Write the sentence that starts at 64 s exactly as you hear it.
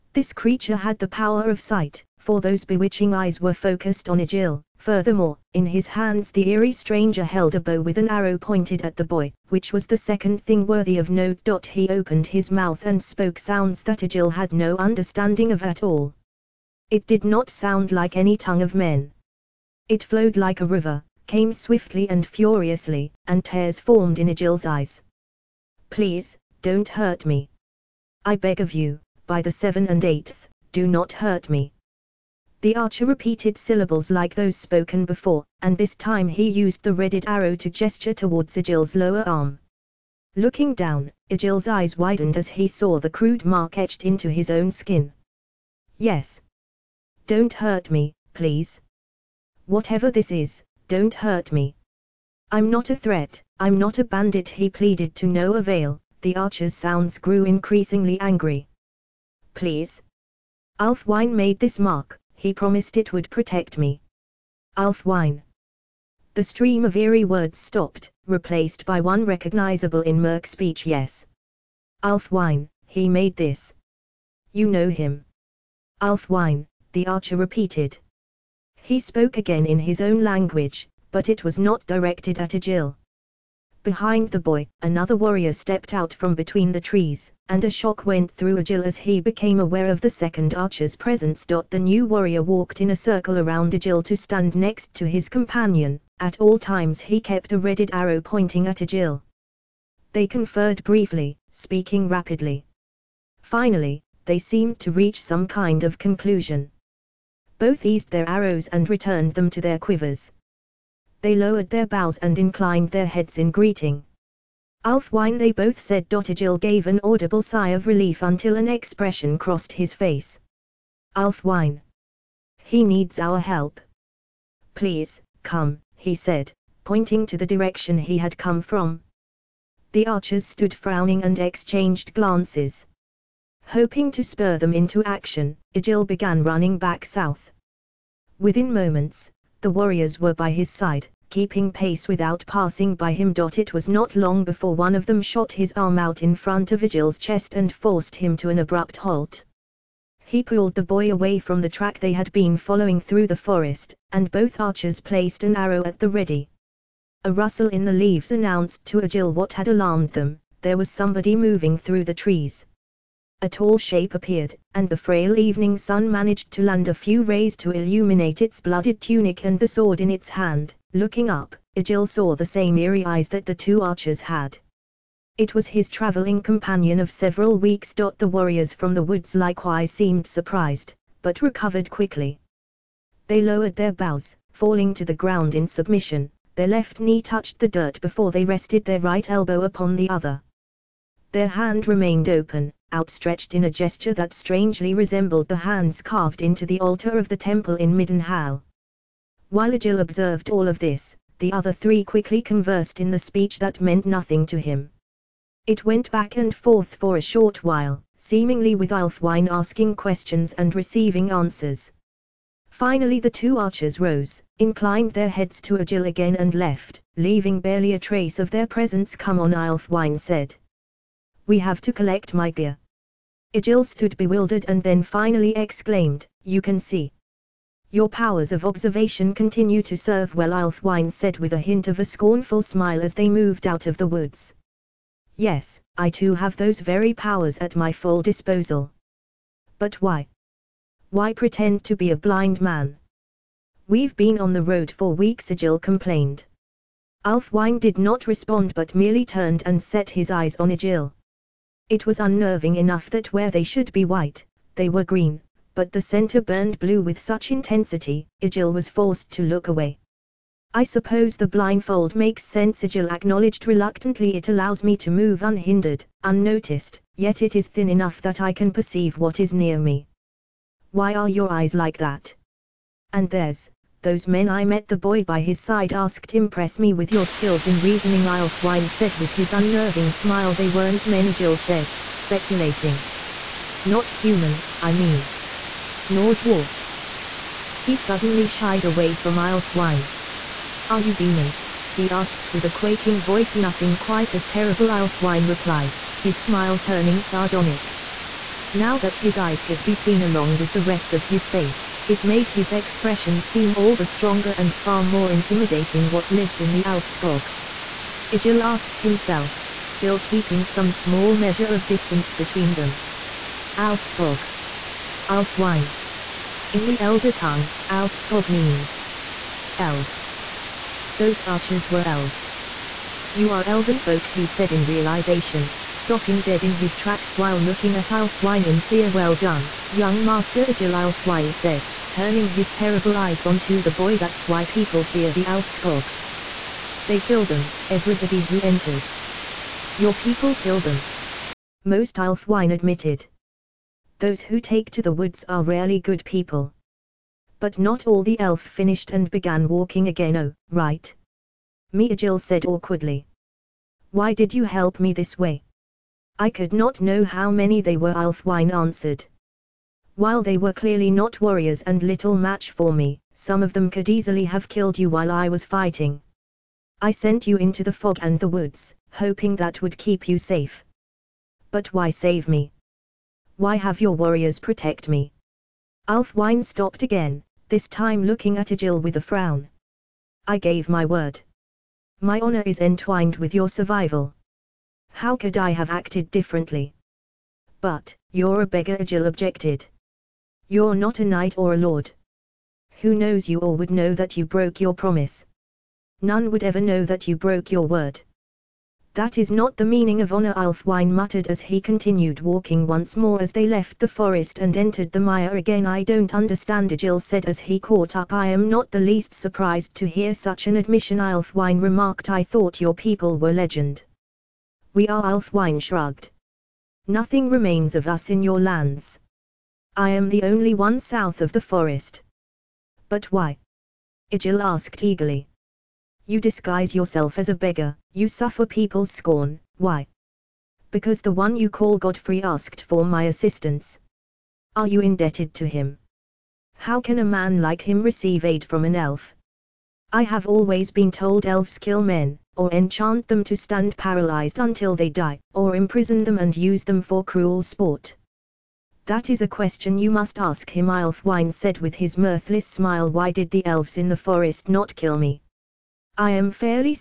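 Alf The stream of eerie words stopped, replaced by one recognizable in Merck's speech yes.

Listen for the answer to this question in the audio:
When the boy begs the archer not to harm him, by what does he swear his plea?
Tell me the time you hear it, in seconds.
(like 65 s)
29 s.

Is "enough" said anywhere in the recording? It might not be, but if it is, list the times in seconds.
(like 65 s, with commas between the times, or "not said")
252 s, 267 s.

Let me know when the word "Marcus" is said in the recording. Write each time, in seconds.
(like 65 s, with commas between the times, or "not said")
not said.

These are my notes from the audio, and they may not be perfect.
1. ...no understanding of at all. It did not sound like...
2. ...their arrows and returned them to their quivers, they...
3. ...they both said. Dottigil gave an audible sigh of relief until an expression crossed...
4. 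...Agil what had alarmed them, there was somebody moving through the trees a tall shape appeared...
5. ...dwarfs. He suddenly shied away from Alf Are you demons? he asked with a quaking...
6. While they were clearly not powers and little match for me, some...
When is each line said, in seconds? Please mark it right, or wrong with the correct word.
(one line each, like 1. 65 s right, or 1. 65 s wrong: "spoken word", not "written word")
1. 14 s right
2. 108 s right
3. 115 s right
4. 159 s right
5. 286 s right
6. 360 s wrong: "warriors", not "powers".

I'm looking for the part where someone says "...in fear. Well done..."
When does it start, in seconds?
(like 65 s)
328 s.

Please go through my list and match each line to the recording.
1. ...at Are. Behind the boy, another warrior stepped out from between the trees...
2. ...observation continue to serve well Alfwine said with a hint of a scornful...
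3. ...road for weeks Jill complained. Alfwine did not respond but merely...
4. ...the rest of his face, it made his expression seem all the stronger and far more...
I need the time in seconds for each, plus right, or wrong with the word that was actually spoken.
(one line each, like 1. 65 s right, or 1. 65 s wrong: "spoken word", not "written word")
1. 82 s wrong: "Agil", not "Are"
2. 228 s right
3. 244 s wrong: "Agil", not "Jill"
4. 300 s right.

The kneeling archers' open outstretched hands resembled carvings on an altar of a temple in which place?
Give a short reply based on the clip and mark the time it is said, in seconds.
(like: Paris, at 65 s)
Middenhall, at 197 s.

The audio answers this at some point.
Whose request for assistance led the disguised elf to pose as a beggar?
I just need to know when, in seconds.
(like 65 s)
431 s.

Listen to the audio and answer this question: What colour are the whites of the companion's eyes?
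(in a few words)
green.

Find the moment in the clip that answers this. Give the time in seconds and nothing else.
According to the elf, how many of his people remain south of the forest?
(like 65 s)
419 s.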